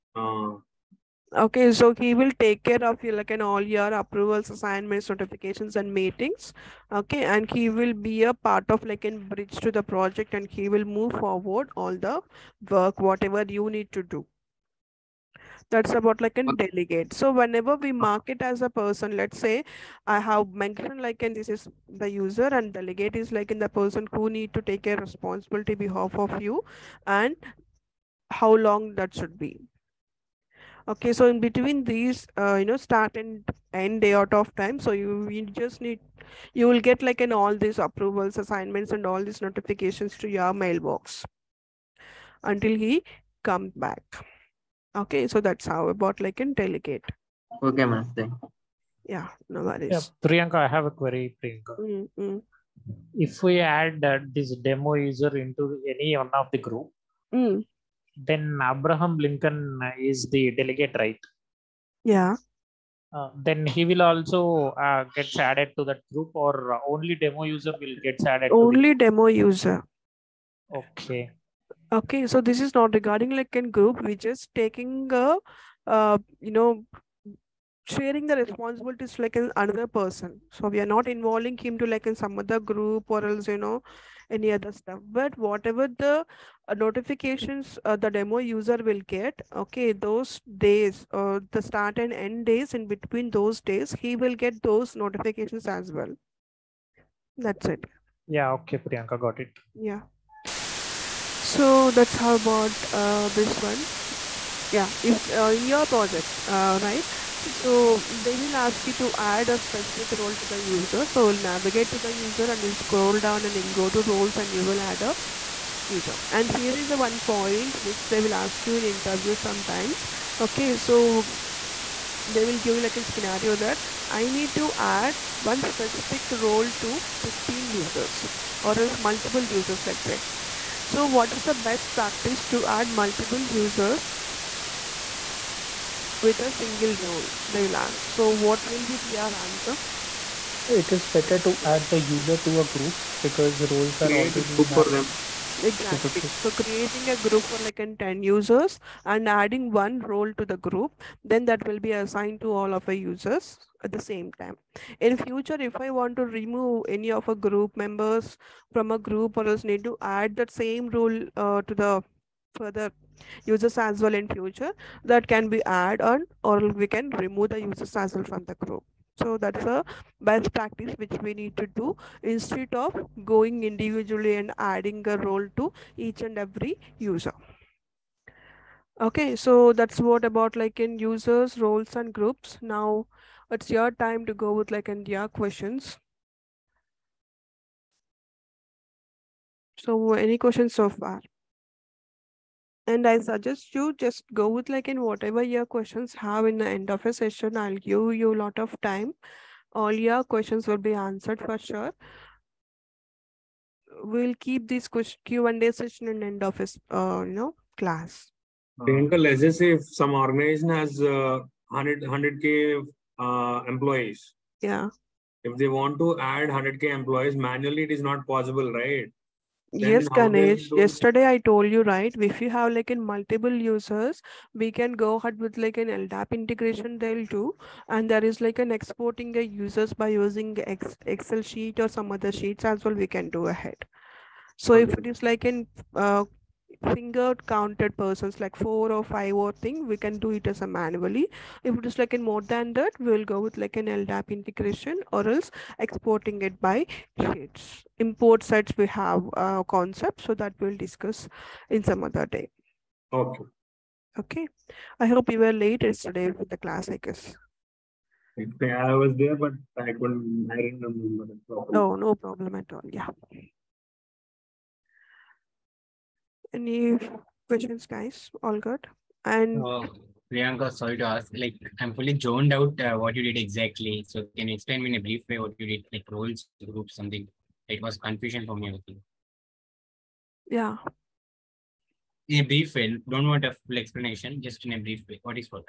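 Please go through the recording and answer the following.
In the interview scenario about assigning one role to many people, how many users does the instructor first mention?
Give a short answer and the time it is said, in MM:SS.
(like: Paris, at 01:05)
15, at 02:07.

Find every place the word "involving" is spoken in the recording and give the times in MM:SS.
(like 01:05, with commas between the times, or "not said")
01:21.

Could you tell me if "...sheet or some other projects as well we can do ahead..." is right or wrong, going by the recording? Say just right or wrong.
wrong.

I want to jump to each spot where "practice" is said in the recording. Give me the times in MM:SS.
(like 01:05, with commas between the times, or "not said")
02:11, 02:50.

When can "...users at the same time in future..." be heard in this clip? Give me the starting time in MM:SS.
02:33.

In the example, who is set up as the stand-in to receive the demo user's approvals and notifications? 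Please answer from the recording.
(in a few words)
Abraham Lincoln.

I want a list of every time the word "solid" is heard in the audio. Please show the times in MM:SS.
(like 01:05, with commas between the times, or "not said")
not said.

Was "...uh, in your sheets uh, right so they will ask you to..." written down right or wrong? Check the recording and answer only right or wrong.
wrong.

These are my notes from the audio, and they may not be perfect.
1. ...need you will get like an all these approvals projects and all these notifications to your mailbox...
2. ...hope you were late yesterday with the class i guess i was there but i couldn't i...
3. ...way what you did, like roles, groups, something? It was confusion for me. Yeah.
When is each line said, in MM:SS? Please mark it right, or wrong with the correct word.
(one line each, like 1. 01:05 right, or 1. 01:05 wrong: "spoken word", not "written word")
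1. 00:35 wrong: "assignments", not "projects"
2. 04:15 right
3. 04:35 right.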